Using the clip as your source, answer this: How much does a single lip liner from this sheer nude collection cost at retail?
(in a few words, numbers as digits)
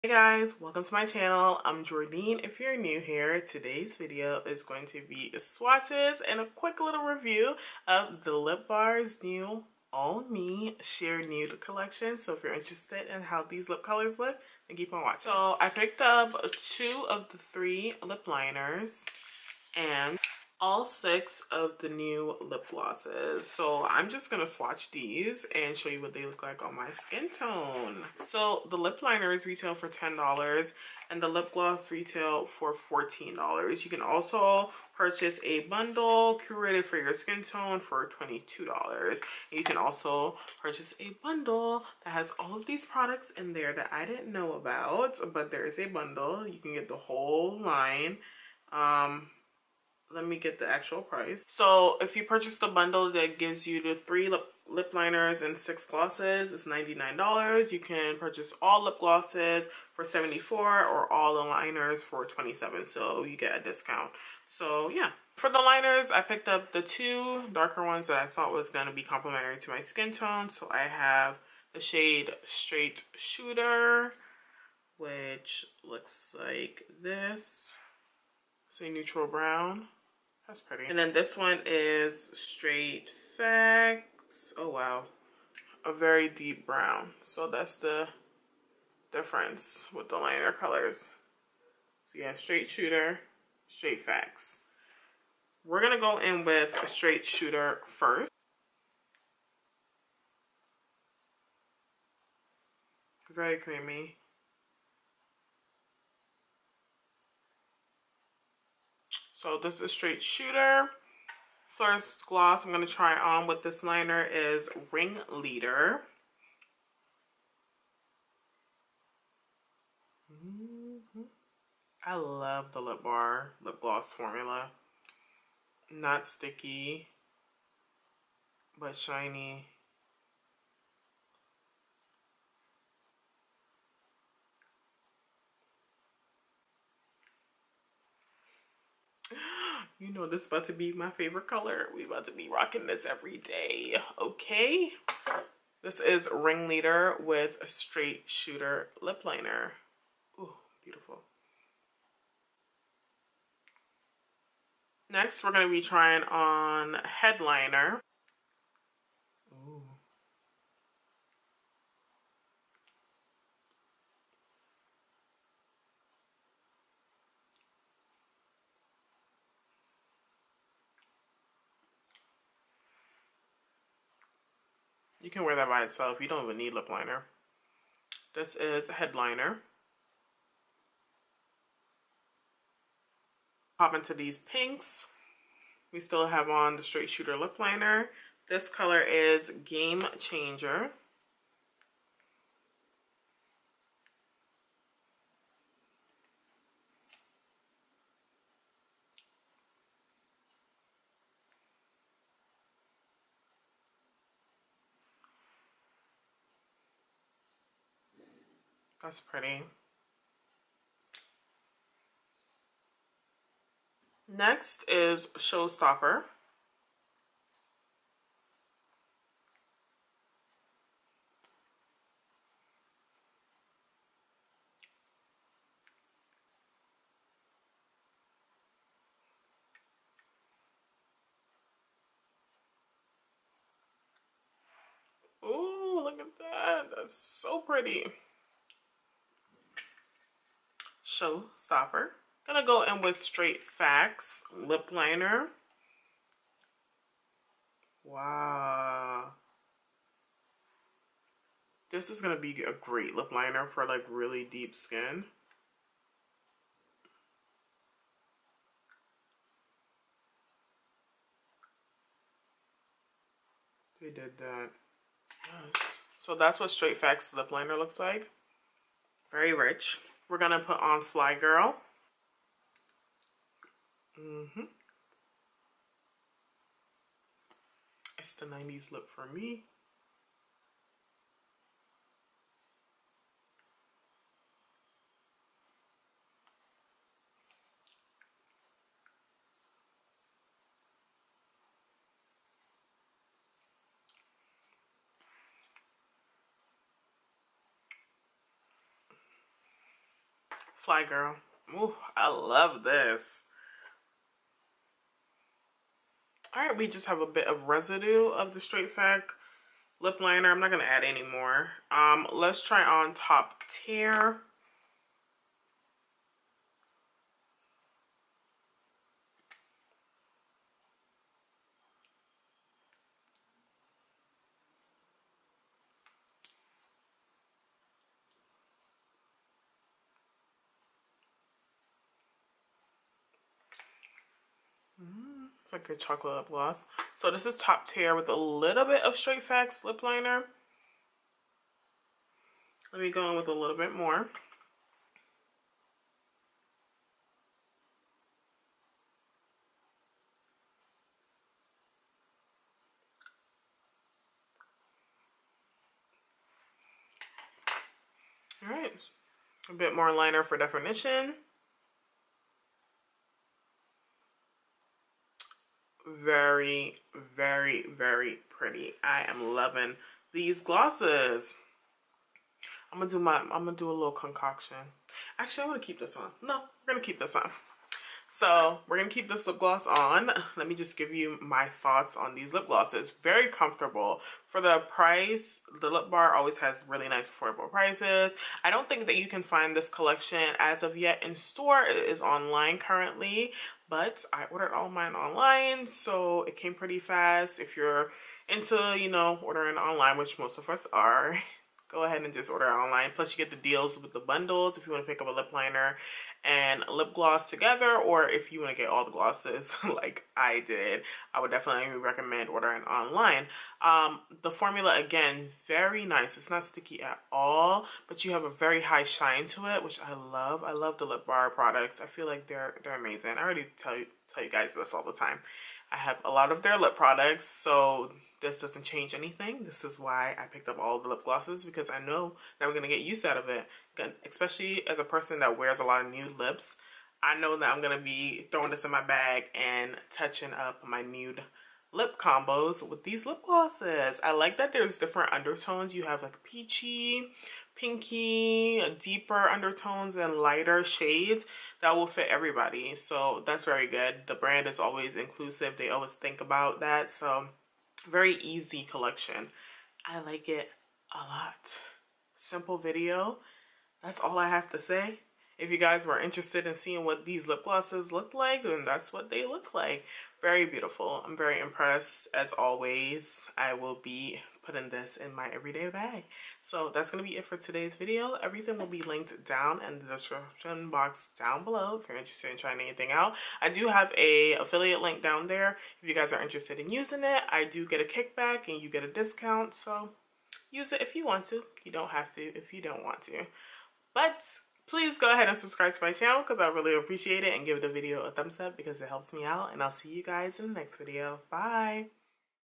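$10.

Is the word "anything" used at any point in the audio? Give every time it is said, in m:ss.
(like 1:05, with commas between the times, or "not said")
7:09, 8:02.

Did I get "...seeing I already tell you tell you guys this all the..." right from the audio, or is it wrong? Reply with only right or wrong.
wrong.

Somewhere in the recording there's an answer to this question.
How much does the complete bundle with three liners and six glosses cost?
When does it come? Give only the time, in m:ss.
0:56.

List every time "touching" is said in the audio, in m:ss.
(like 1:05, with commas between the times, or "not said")
7:20.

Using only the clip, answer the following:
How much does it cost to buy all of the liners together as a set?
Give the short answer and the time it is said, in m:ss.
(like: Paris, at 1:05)
27, at 1:02.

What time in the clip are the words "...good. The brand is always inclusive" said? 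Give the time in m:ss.
7:33.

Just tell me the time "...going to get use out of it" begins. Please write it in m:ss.
7:12.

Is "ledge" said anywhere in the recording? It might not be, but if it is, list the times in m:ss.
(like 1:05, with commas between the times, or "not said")
not said.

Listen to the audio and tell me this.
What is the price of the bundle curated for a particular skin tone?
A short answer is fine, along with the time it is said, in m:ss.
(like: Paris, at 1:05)
$22, at 0:38.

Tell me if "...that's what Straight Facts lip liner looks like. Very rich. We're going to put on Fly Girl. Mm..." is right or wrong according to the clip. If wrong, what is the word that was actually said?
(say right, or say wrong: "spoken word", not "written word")
right.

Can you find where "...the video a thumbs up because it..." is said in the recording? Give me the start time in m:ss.
8:17.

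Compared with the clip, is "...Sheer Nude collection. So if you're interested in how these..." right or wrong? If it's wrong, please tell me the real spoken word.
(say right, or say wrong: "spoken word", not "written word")
right.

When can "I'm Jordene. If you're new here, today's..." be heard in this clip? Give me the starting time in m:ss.
0:01.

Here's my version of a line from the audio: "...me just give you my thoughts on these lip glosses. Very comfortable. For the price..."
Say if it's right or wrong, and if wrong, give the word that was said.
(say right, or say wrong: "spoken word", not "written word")
right.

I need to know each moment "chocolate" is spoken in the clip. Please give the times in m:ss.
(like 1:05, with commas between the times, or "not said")
5:36.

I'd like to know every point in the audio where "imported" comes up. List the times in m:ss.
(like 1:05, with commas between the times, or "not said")
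not said.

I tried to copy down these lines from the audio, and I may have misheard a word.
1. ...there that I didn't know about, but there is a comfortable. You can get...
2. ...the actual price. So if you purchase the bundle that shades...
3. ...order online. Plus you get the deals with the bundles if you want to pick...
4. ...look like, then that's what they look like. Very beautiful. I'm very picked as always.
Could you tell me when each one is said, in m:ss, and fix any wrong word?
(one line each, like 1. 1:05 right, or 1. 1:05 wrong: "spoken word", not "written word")
1. 0:43 wrong: "bundle", not "comfortable"
2. 0:50 wrong: "gives", not "shades"
3. 6:42 right
4. 7:48 wrong: "impressed", not "picked".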